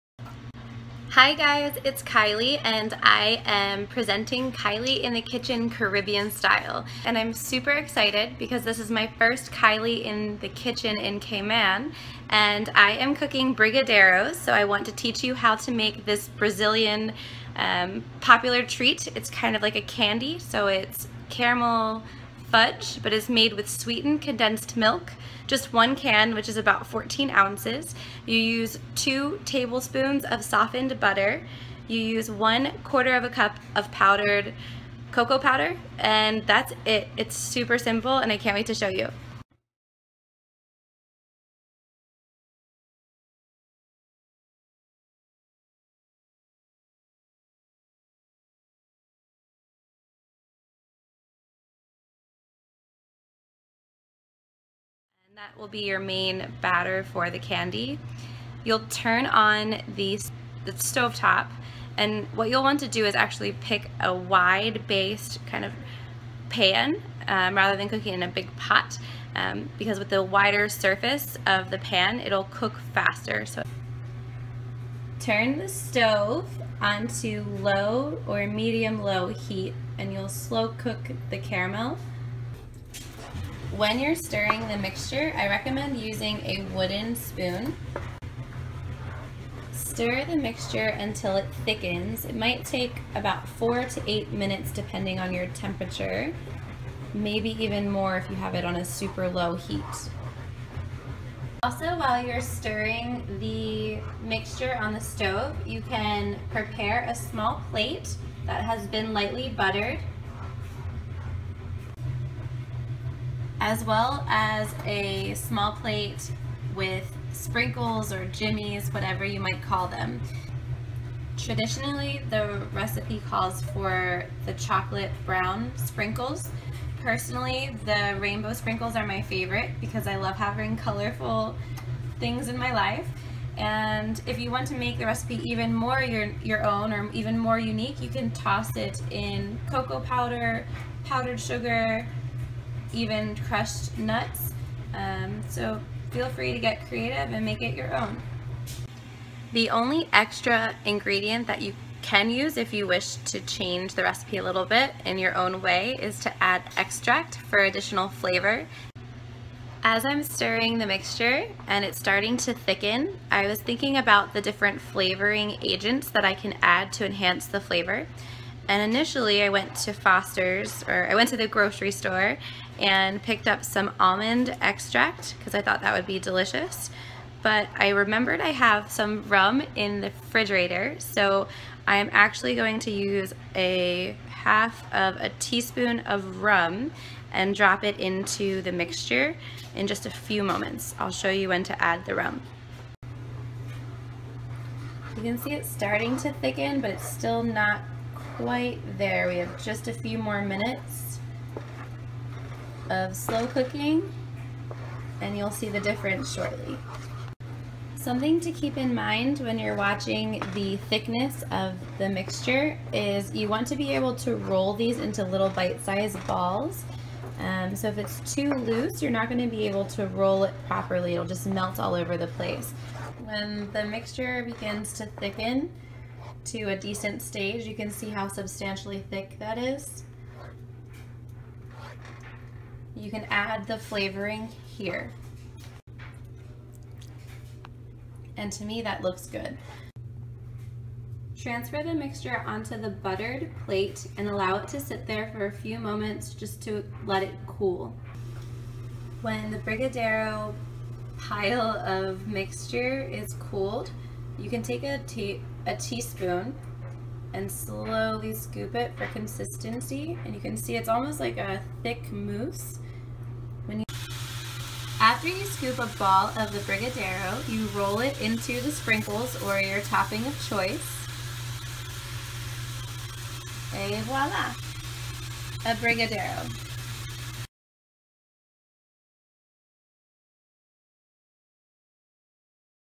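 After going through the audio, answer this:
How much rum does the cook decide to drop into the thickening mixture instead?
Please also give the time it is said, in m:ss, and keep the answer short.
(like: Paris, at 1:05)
1/2 teaspoon, at 3:03.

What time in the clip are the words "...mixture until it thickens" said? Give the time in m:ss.
1:30.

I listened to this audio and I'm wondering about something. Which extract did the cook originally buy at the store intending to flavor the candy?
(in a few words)
almond extract.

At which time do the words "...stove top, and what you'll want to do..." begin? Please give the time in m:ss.
1:00.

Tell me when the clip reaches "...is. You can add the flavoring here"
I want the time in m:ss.
3:49.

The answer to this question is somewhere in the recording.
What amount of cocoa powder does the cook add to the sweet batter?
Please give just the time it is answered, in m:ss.
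0:32.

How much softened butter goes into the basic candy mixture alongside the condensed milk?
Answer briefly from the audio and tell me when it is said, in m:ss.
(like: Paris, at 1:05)
2 tablespoons, at 0:28.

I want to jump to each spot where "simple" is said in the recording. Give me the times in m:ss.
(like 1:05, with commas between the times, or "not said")
0:37.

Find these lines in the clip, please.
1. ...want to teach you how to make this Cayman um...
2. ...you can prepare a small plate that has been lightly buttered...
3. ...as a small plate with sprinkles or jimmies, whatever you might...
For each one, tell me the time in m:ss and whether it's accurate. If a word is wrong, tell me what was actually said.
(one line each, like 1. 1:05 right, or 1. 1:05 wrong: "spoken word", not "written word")
1. 0:14 wrong: "Brazilian", not "Cayman"
2. 1:45 right
3. 1:54 right.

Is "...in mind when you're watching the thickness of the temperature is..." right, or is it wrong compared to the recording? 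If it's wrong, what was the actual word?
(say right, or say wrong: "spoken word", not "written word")
wrong: "mixture", not "temperature".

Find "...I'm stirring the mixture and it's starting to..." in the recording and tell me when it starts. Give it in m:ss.
2:40.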